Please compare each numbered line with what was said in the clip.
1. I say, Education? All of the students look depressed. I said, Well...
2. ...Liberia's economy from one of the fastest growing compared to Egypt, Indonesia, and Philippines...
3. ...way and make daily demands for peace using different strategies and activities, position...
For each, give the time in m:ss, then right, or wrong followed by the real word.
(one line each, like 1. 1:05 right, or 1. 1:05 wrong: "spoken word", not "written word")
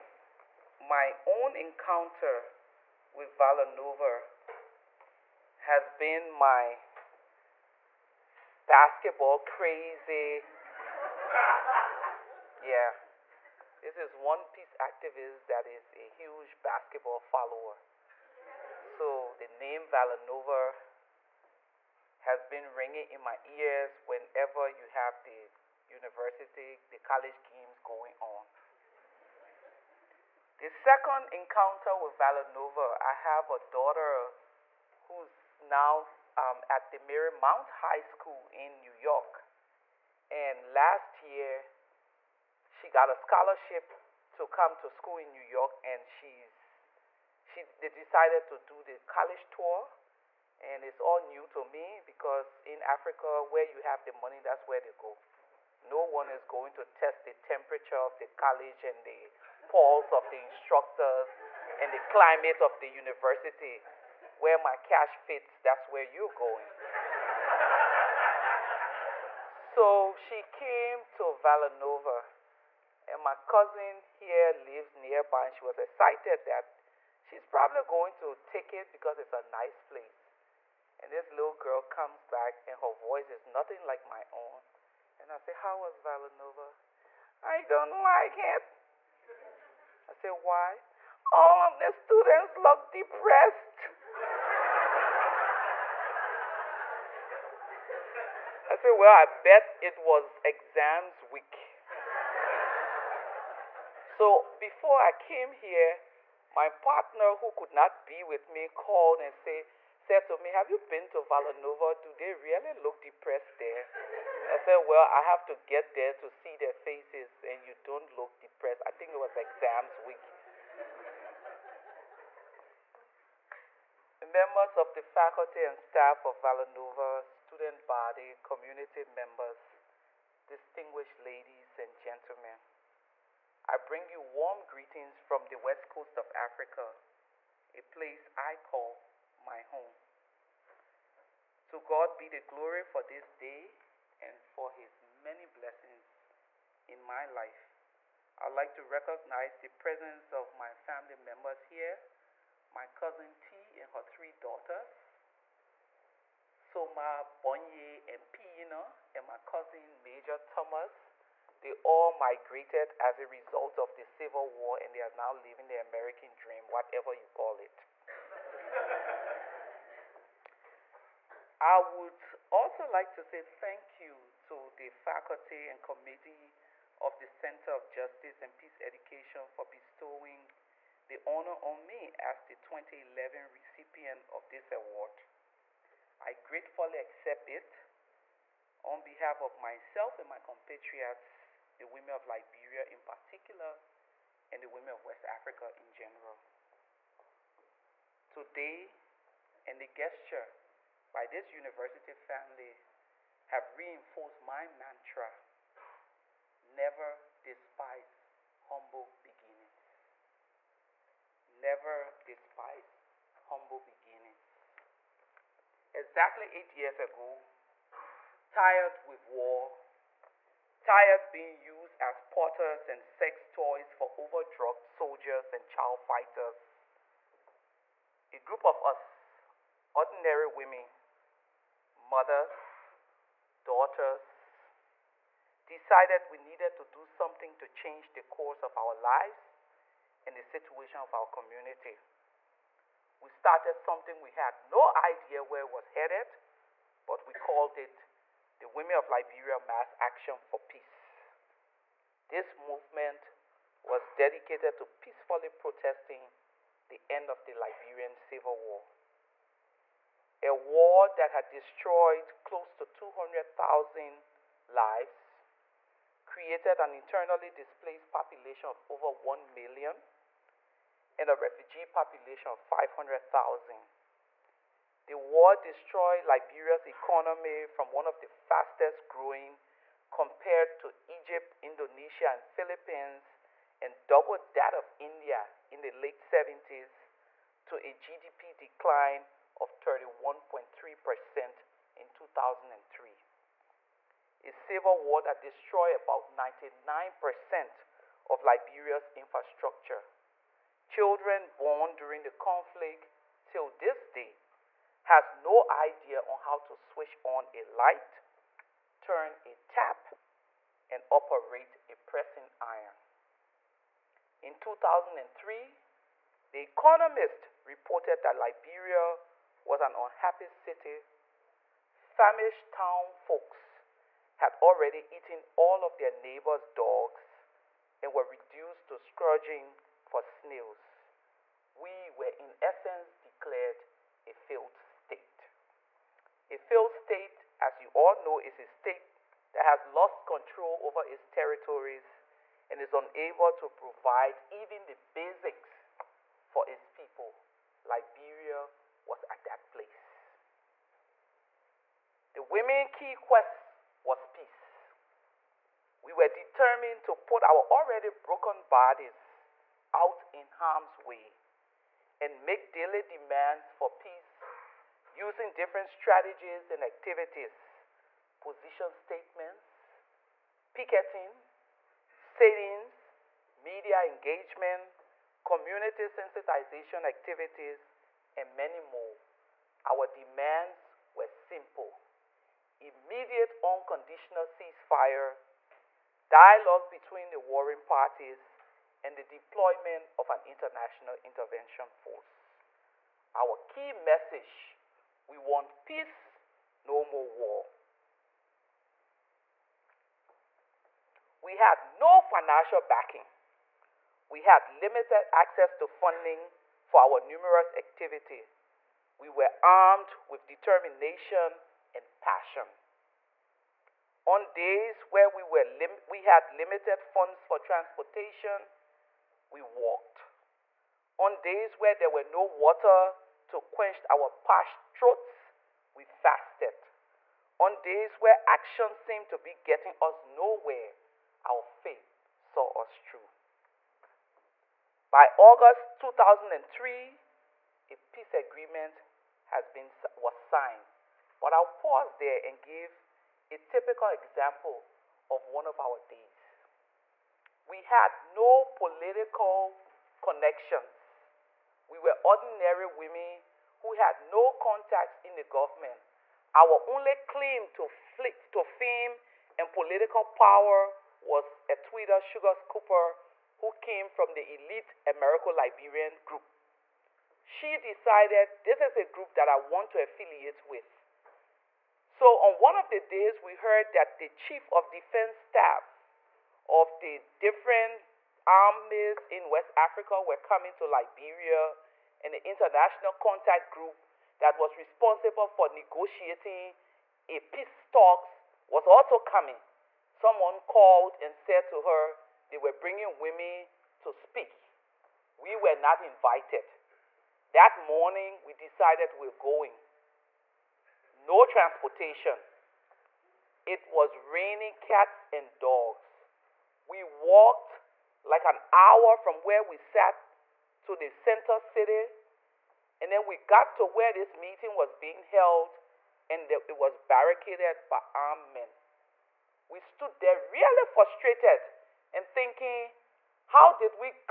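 1. 1:30 wrong: "Why", not "Education"
2. 4:36 right
3. 6:00 right.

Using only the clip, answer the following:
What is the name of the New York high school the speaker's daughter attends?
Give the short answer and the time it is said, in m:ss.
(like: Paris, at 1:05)
Marymount High School, at 0:36.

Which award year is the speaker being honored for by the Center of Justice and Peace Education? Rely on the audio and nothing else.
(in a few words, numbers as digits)
2011.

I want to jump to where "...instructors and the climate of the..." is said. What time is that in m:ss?
1:00.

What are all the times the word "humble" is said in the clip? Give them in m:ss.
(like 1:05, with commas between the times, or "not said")
3:28, 3:33.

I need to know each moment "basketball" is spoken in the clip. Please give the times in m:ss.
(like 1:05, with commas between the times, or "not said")
0:08, 0:16.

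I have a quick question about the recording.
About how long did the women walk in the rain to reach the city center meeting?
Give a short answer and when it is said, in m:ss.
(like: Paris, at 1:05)
an hour, at 8:28.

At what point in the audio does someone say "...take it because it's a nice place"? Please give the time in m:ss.
1:18.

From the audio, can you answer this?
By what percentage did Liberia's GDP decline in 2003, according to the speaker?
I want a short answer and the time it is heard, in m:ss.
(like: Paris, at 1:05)
31.3%, at 4:49.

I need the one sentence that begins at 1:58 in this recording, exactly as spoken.
I think it was exams week.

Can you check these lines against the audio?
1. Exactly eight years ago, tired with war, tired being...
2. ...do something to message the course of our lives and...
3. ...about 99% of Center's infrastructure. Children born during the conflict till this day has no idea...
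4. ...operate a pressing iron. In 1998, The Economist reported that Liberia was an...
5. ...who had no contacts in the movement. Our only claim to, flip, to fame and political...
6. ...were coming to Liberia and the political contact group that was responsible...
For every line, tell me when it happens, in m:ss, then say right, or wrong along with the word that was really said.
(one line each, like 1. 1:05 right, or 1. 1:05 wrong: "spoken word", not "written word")
1. 3:35 right
2. 3:56 wrong: "change", not "message"
3. 4:55 wrong: "Liberia", not "Center"
4. 5:11 wrong: "2003", not "1998"
5. 7:33 wrong: "government", not "movement"
6. 8:00 wrong: "international", not "political".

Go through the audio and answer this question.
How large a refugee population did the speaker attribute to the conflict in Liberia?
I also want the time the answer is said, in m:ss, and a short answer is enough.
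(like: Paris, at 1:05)
500,000, at 4:32.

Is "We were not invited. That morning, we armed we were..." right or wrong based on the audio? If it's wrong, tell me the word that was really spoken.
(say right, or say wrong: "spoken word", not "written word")
wrong: "decided", not "armed".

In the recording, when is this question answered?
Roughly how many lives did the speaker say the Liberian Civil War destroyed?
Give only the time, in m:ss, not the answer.
4:22.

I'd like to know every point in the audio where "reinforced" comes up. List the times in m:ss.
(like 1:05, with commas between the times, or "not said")
3:23.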